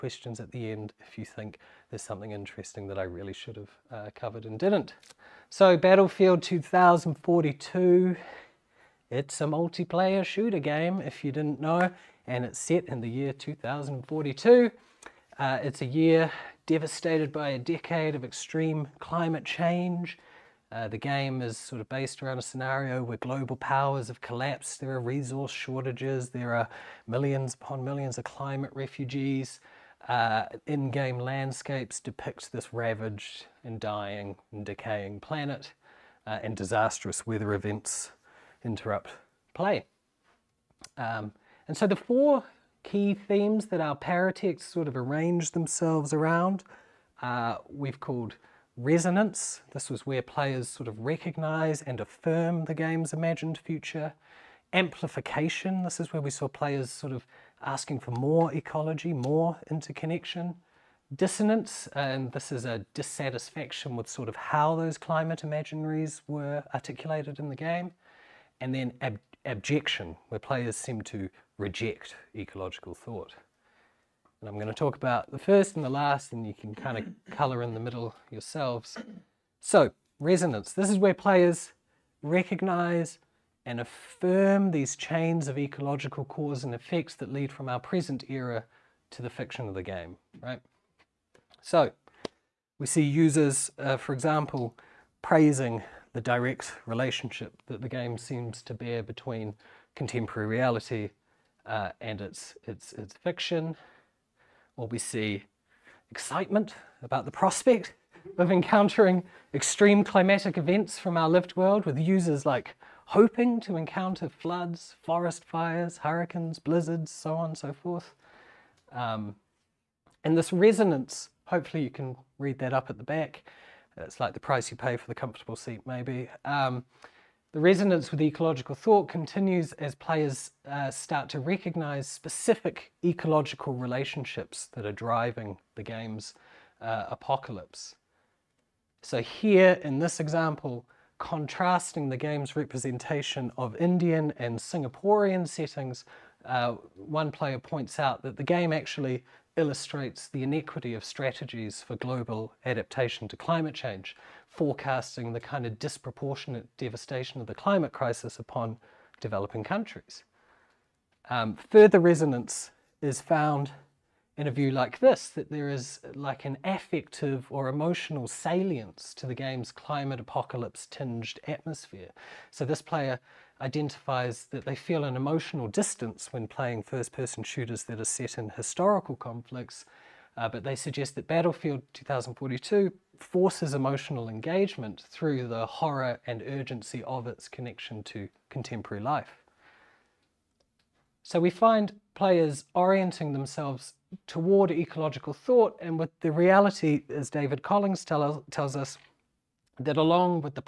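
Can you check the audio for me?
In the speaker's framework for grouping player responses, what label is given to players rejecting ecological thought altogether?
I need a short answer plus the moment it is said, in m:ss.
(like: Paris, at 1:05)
Abjection, at 1:09.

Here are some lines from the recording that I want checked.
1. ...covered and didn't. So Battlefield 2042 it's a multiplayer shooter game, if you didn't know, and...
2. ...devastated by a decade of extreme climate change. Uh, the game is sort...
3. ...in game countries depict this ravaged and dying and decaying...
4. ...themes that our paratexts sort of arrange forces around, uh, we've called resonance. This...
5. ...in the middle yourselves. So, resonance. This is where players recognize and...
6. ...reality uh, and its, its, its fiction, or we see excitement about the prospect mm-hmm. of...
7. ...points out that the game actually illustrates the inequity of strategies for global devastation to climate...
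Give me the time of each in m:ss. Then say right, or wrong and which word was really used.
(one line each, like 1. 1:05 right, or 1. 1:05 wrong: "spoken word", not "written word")
1. 0:04 right
2. 0:16 right
3. 0:30 wrong: "landscapes", not "countries"
4. 0:43 wrong: "themselves", not "forces"
5. 1:17 right
6. 1:40 right
7. 2:27 wrong: "adaptation", not "devastation".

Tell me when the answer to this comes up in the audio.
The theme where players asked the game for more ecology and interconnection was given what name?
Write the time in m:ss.
0:54.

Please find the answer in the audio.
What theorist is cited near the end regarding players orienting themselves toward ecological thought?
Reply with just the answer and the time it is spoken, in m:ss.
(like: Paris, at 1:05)
David Collings, at 3:17.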